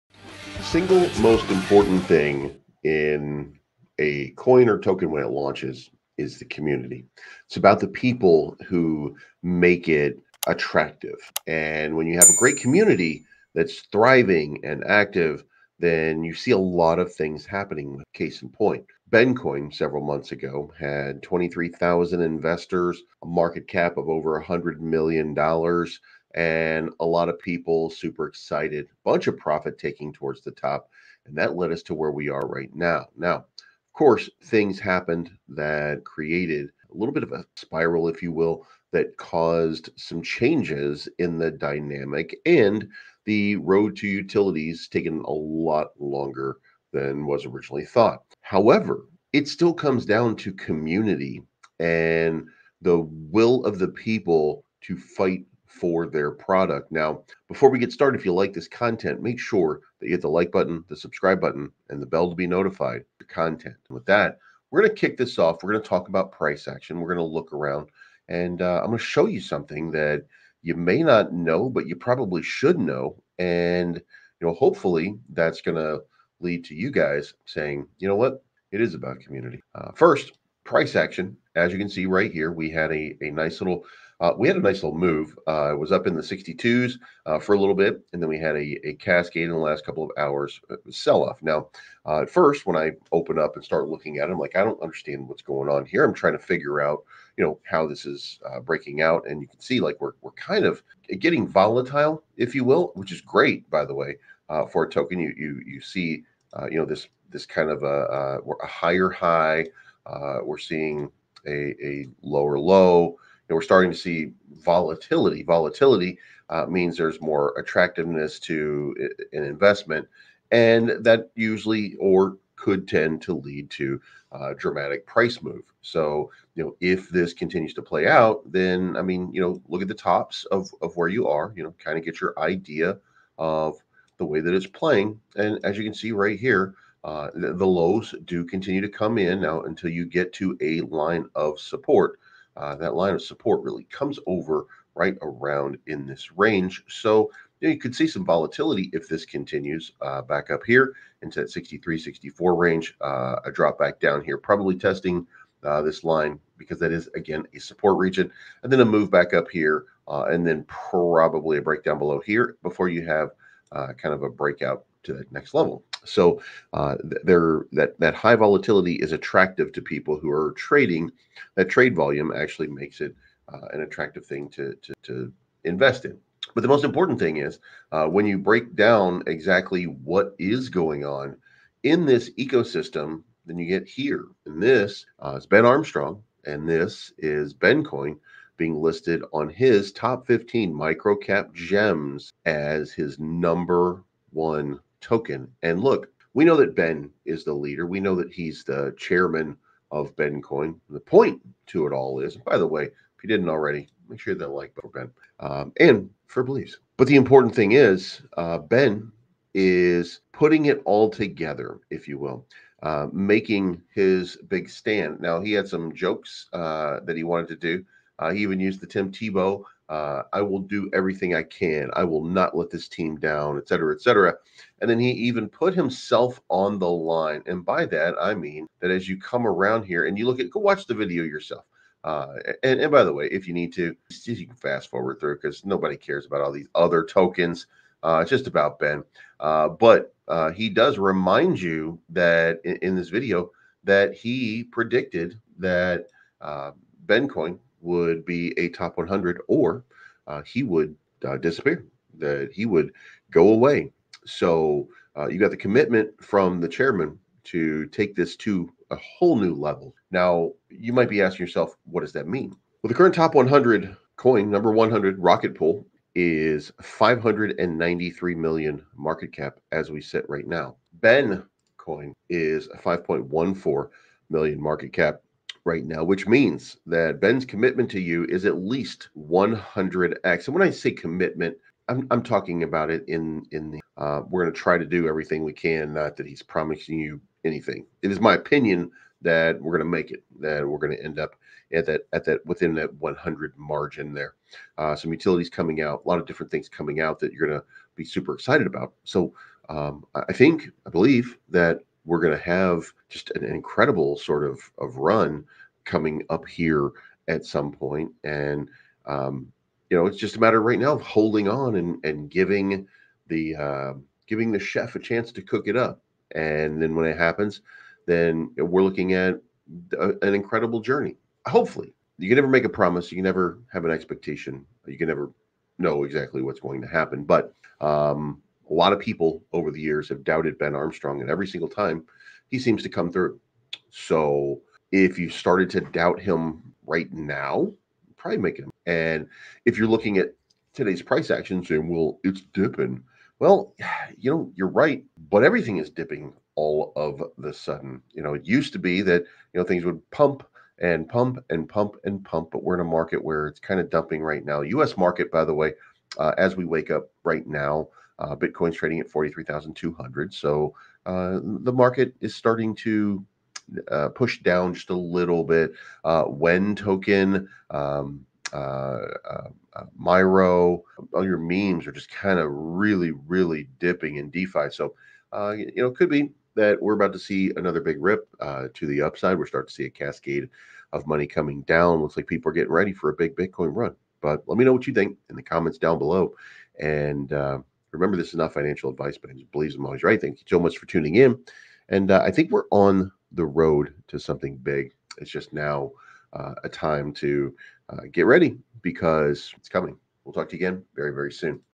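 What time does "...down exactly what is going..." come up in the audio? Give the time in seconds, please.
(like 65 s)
178 s.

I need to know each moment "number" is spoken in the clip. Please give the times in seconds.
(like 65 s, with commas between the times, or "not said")
193 s, 264 s.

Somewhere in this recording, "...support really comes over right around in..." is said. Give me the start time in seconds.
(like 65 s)
143 s.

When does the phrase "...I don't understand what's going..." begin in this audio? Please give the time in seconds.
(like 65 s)
94 s.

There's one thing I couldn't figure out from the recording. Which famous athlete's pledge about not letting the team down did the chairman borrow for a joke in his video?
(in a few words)
Tim Tebow.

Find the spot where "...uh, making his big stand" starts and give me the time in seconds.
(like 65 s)
212 s.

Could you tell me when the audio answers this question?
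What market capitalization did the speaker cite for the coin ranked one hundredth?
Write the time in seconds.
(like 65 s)
266 s.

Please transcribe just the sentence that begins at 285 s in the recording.
Not that he's promising you anything.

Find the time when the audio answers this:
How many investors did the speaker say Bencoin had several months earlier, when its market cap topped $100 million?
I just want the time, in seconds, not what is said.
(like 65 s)
21 s.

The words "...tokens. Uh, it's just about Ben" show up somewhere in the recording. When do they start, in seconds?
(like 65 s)
237 s.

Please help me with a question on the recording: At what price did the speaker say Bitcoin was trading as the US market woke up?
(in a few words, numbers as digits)
43,200.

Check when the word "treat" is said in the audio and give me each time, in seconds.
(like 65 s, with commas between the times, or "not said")
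not said.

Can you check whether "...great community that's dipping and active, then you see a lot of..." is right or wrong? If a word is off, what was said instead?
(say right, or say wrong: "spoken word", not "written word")
wrong: "thriving", not "dipping".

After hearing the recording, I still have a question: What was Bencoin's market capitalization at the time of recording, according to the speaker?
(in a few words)
$5.14 million.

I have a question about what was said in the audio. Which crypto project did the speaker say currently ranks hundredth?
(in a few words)
Rocket Pool.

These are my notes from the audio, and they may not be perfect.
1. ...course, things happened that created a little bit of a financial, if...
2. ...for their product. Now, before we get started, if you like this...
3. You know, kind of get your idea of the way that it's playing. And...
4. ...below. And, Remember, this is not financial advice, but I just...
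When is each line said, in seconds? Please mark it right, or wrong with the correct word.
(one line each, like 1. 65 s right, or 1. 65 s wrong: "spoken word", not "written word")
1. 33 s wrong: "spiral", not "financial"
2. 55 s right
3. 131 s right
4. 385 s right.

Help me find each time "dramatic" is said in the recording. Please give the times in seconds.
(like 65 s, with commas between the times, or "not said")
124 s.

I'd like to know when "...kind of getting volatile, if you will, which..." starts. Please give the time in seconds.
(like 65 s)
100 s.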